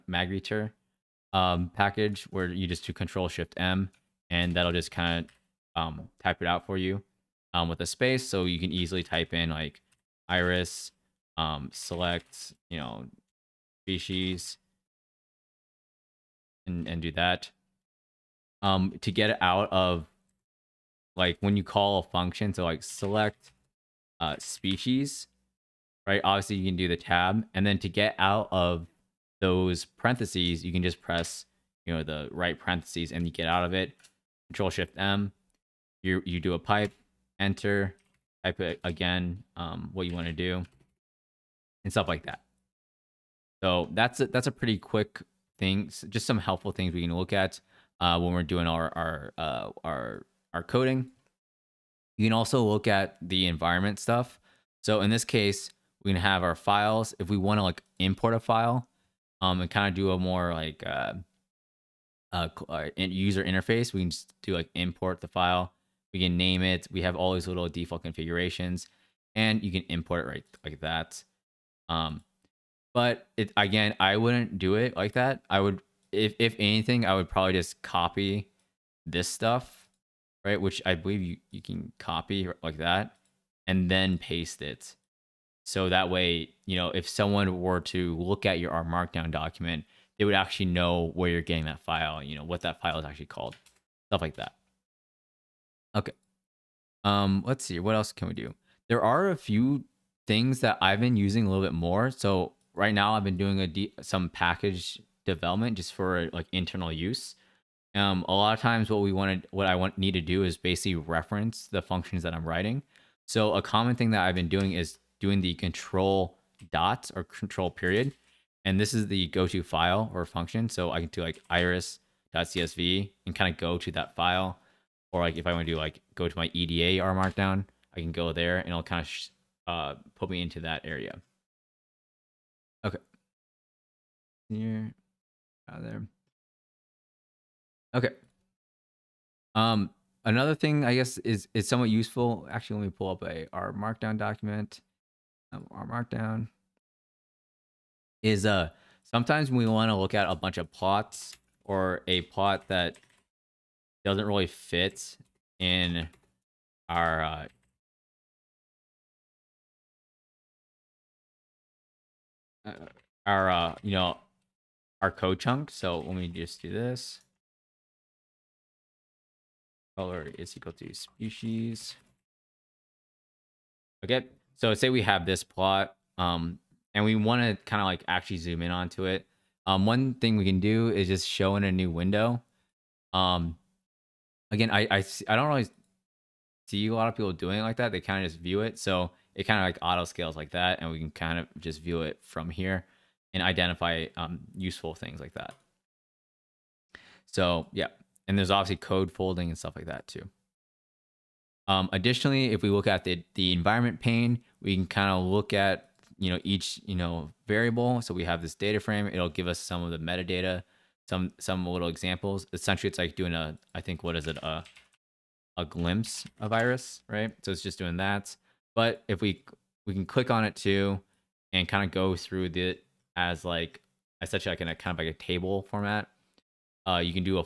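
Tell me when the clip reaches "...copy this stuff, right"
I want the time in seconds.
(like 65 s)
77 s.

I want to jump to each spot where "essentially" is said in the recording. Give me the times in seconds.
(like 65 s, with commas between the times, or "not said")
212 s, 224 s.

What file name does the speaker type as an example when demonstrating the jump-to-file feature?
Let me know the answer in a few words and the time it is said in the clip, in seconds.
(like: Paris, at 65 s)
iris.csv, at 121 s.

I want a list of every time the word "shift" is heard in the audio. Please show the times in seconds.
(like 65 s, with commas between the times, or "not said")
3 s, 34 s.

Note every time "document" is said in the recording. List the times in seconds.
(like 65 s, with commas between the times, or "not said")
89 s, 144 s.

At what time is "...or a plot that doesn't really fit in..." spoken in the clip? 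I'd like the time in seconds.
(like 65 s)
151 s.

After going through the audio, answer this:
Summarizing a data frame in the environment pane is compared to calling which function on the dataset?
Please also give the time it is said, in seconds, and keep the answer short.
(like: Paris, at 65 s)
glimpse, at 215 s.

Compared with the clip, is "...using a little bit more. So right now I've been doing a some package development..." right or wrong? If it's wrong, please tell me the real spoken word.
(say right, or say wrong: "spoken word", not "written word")
right.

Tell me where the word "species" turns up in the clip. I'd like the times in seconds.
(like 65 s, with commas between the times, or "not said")
13 s, 24 s, 170 s.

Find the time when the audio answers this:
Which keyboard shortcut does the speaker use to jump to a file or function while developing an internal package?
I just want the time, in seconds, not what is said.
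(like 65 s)
117 s.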